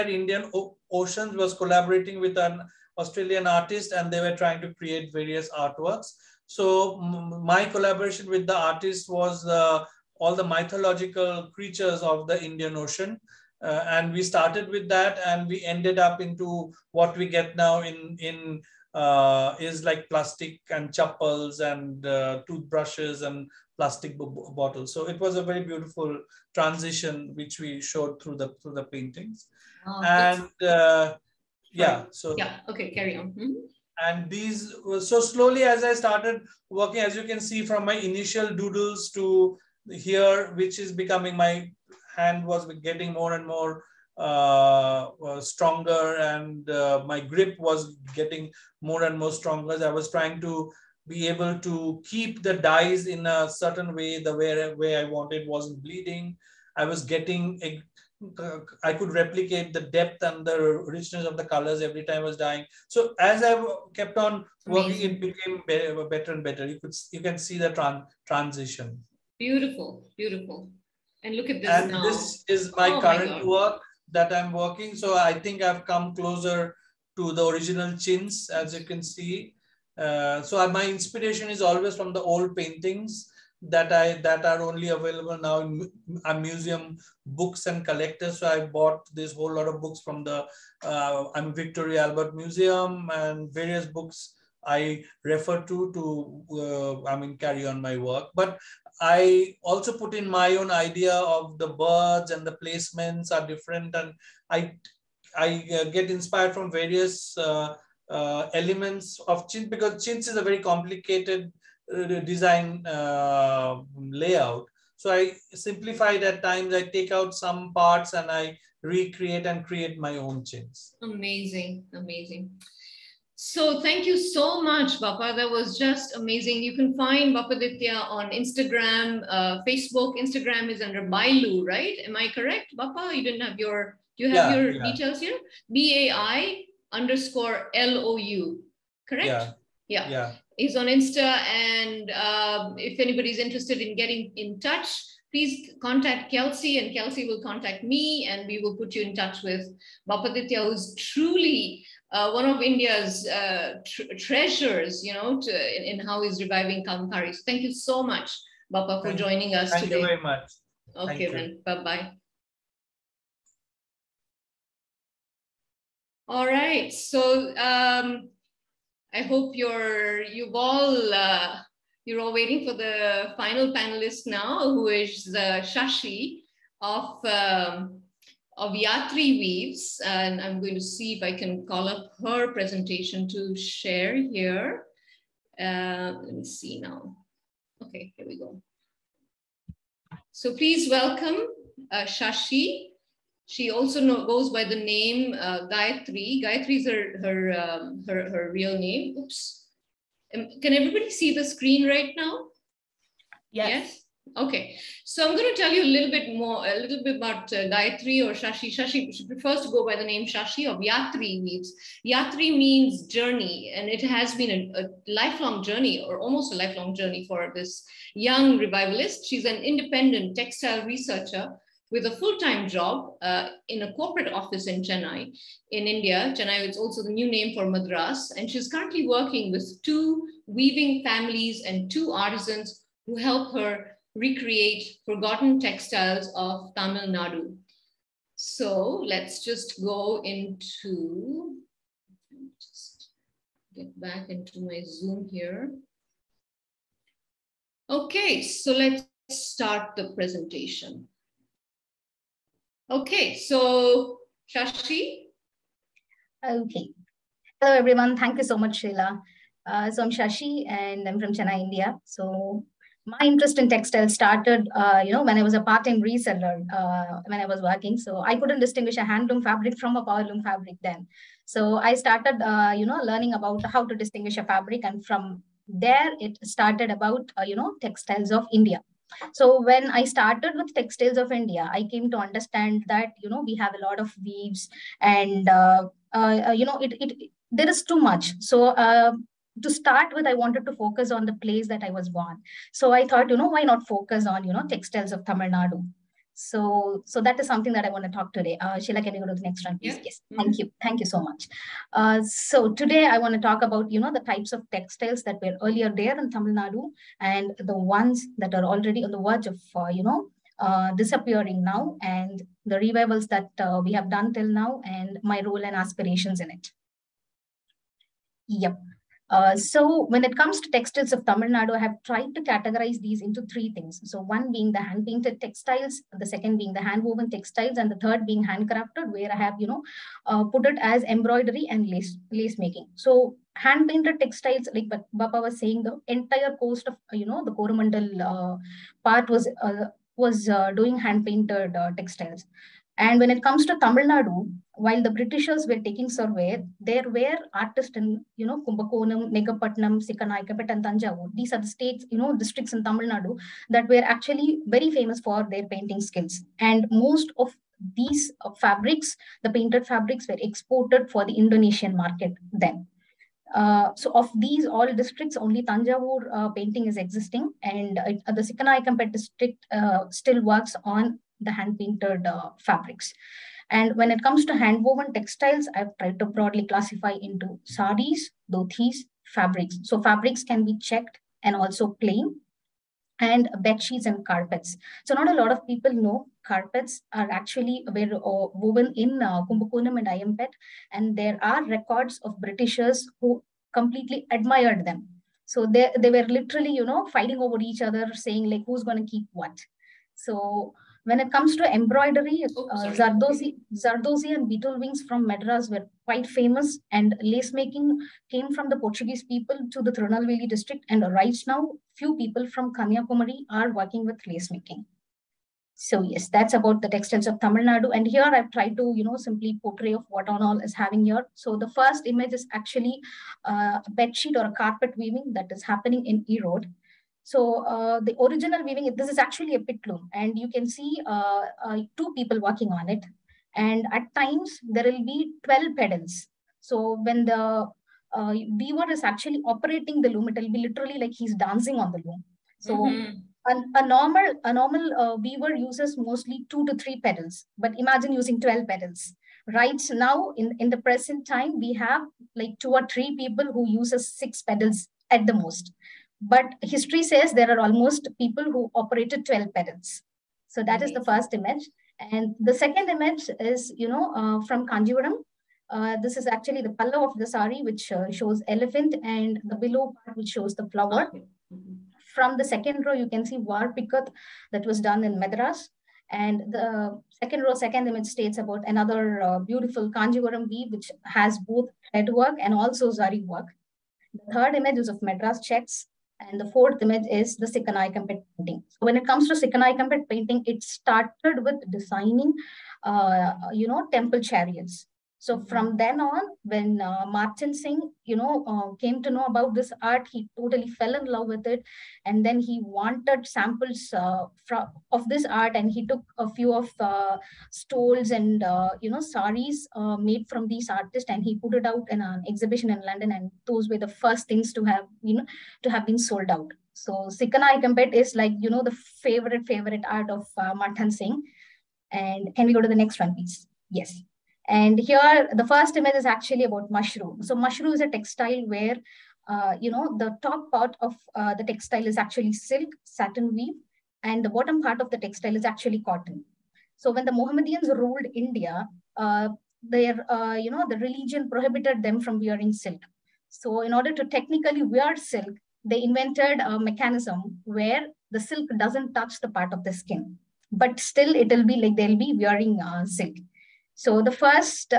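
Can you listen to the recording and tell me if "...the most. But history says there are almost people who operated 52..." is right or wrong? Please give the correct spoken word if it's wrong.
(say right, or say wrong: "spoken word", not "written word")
wrong: "12", not "52".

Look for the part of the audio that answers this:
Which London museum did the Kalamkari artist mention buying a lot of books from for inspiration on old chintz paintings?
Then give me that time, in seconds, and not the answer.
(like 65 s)
91 s.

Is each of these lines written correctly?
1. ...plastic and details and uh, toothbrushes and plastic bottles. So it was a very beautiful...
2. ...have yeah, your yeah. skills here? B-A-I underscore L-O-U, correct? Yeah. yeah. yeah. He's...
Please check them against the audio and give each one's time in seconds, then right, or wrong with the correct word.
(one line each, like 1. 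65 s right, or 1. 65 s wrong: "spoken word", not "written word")
1. 20 s wrong: "chappals", not "details"
2. 134 s wrong: "details", not "skills".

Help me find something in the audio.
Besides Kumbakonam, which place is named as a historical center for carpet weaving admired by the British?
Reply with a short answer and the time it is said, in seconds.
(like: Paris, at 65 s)
Ayampet, at 390 s.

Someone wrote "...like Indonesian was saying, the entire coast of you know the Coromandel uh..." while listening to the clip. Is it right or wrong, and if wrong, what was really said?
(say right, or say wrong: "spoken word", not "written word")
wrong: "Bappa", not "Indonesian".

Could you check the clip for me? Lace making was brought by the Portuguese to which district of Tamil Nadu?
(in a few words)
Tirunelveli.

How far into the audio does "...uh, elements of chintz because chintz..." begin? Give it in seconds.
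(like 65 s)
108 s.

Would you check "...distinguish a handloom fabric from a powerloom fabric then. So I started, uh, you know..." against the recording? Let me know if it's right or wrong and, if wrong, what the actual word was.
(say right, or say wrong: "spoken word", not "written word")
right.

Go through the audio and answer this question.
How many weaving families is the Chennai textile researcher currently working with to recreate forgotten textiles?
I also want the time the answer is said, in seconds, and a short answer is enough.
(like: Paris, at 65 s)
2, at 229 s.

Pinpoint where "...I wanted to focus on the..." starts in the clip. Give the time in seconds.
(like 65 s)
290 s.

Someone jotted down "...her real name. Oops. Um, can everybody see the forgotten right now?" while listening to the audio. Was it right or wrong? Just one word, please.
wrong.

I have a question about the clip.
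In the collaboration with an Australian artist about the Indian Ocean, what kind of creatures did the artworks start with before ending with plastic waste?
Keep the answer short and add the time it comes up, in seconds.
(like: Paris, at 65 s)
Mythological creatures, at 10 s.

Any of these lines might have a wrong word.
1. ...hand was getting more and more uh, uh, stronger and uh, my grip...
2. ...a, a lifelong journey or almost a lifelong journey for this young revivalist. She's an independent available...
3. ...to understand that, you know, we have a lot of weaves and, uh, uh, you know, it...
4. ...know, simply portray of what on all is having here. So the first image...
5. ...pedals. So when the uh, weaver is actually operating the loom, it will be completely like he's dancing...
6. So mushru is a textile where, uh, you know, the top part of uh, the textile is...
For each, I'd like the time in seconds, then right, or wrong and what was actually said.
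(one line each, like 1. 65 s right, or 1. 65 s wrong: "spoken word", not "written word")
1. 42 s right
2. 214 s wrong: "textile", not "available"
3. 282 s right
4. 419 s right
5. 435 s wrong: "literally", not "completely"
6. 527 s right.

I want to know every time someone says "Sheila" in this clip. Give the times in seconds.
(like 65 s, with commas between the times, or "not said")
258 s, 298 s.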